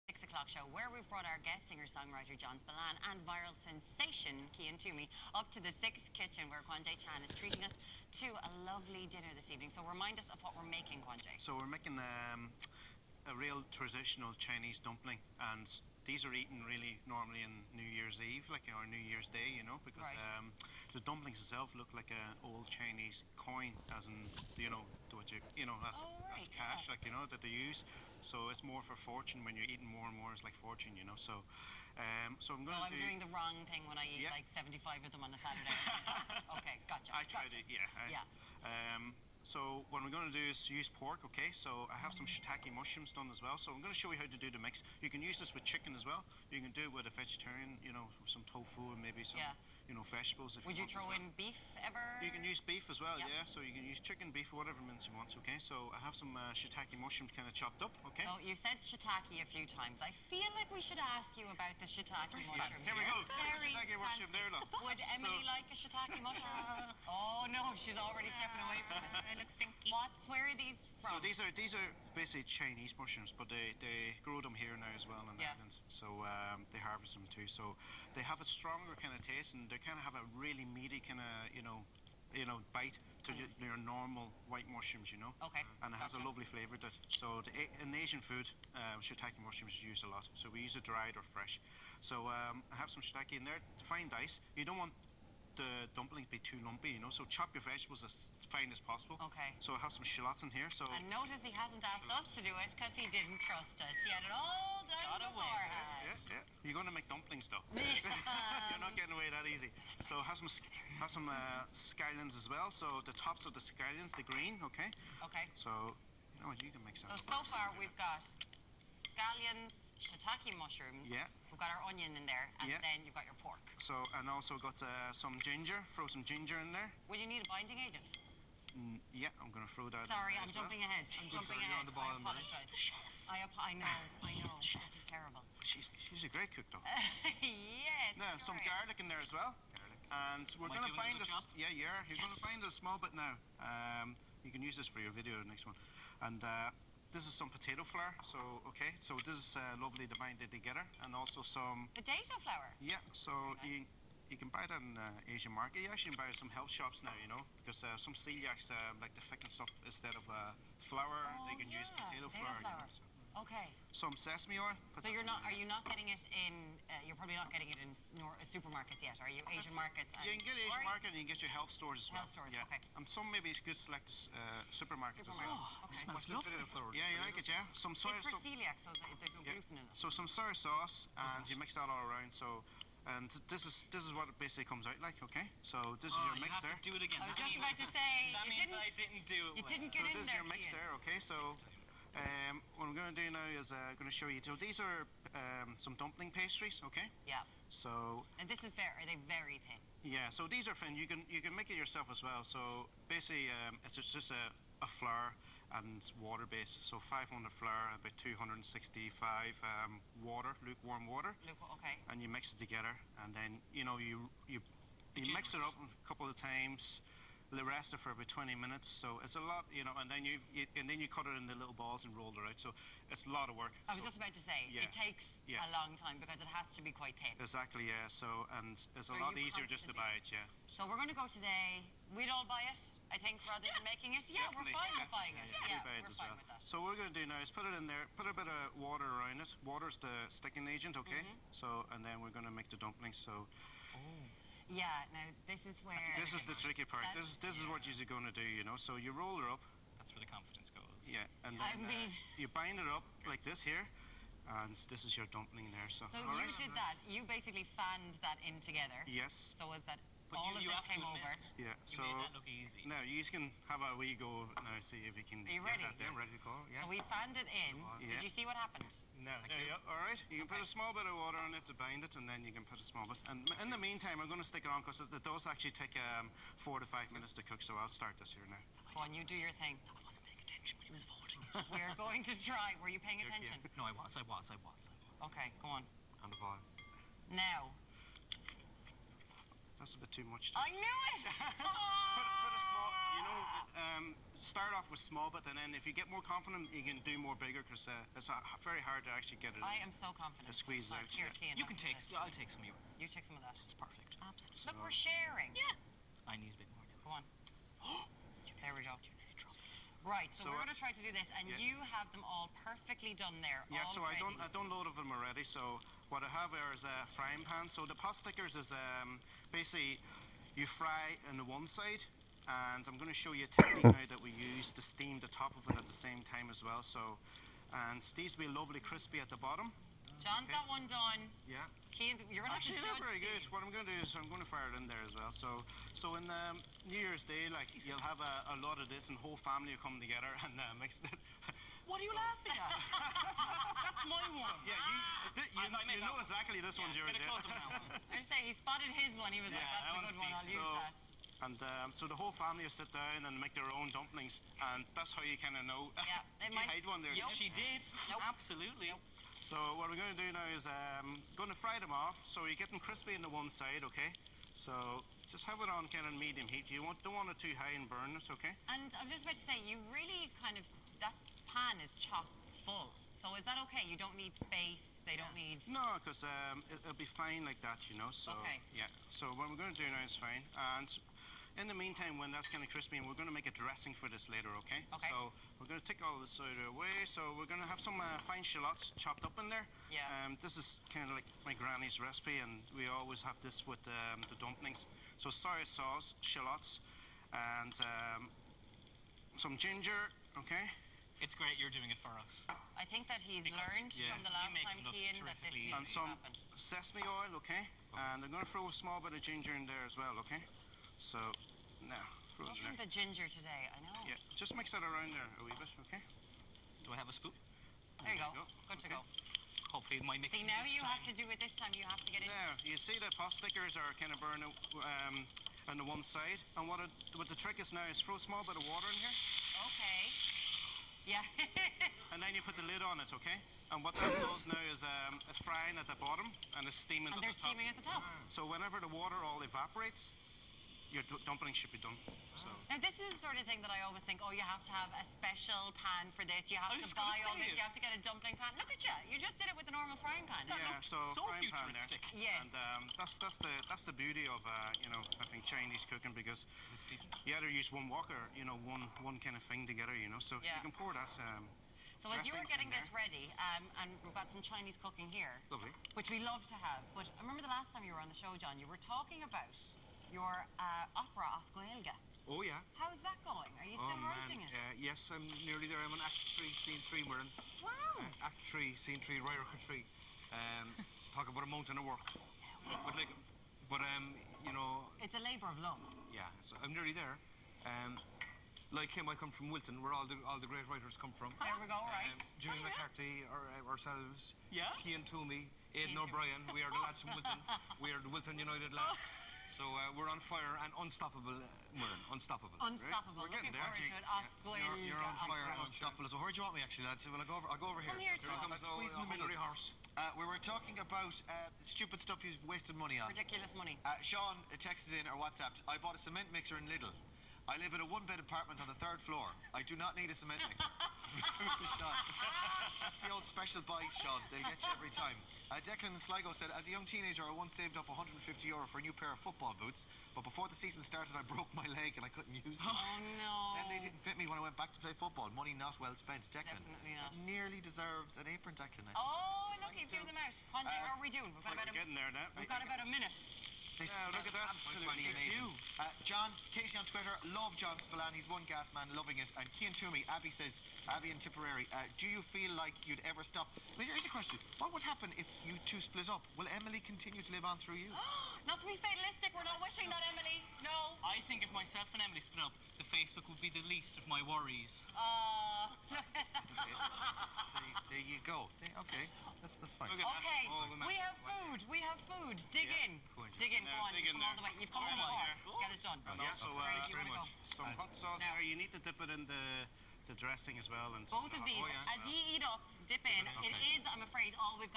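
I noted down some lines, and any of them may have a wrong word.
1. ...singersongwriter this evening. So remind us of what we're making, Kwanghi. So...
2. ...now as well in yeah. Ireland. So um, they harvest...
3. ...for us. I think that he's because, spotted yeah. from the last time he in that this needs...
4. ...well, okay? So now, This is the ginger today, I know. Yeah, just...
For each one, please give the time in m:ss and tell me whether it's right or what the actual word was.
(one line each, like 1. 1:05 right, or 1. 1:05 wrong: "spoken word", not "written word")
1. 0:09 wrong: "dinner", not "singersongwriter"
2. 1:14 right
3. 6:42 wrong: "learned", not "spotted"
4. 6:49 right.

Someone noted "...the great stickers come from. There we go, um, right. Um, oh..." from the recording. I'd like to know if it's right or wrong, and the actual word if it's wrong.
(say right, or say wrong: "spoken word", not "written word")
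wrong: "writers", not "stickers".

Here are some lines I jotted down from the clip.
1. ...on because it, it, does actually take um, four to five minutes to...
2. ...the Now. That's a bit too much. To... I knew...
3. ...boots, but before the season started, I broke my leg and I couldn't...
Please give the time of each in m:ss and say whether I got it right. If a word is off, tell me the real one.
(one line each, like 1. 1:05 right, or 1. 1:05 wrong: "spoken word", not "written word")
1. 4:34 right
2. 4:46 right
3. 8:49 right.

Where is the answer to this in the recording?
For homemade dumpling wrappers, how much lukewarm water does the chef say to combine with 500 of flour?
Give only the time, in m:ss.
3:28.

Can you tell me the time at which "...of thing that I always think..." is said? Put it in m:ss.
7:23.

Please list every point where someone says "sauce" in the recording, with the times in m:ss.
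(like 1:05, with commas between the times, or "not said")
3:00, 6:35, 9:37.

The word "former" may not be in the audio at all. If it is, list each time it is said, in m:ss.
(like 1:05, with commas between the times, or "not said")
not said.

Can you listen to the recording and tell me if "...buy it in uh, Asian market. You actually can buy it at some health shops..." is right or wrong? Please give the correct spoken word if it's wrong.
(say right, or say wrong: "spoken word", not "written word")
right.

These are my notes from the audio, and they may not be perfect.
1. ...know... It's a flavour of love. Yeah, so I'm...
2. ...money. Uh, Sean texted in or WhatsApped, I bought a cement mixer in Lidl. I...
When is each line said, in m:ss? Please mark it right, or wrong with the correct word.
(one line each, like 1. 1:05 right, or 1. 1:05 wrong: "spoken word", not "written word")
1. 8:04 wrong: "labour", not "flavour"
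2. 8:33 right.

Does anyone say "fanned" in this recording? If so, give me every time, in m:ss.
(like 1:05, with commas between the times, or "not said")
4:17, 4:27.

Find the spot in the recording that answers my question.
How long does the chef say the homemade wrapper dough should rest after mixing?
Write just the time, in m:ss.
3:38.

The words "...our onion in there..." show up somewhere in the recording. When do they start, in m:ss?
2:01.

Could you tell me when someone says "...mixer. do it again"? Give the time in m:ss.
3:06.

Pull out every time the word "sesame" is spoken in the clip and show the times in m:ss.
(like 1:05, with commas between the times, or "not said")
2:44, 6:46.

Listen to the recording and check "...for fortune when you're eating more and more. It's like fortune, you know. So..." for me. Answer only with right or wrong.
right.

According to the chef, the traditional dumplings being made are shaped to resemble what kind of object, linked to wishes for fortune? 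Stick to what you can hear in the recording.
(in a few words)
Old Chinese coin.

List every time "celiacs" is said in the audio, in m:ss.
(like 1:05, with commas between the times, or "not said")
2:38, 2:58.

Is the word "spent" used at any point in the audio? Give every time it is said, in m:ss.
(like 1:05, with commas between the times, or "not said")
8:55.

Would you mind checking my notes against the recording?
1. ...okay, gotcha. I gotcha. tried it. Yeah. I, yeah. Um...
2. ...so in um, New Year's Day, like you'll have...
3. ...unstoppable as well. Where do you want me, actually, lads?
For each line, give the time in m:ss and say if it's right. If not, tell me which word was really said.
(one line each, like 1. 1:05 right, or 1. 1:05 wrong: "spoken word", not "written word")
1. 0:36 right
2. 5:35 right
3. 8:25 right.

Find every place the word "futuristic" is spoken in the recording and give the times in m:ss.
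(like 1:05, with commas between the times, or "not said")
7:31.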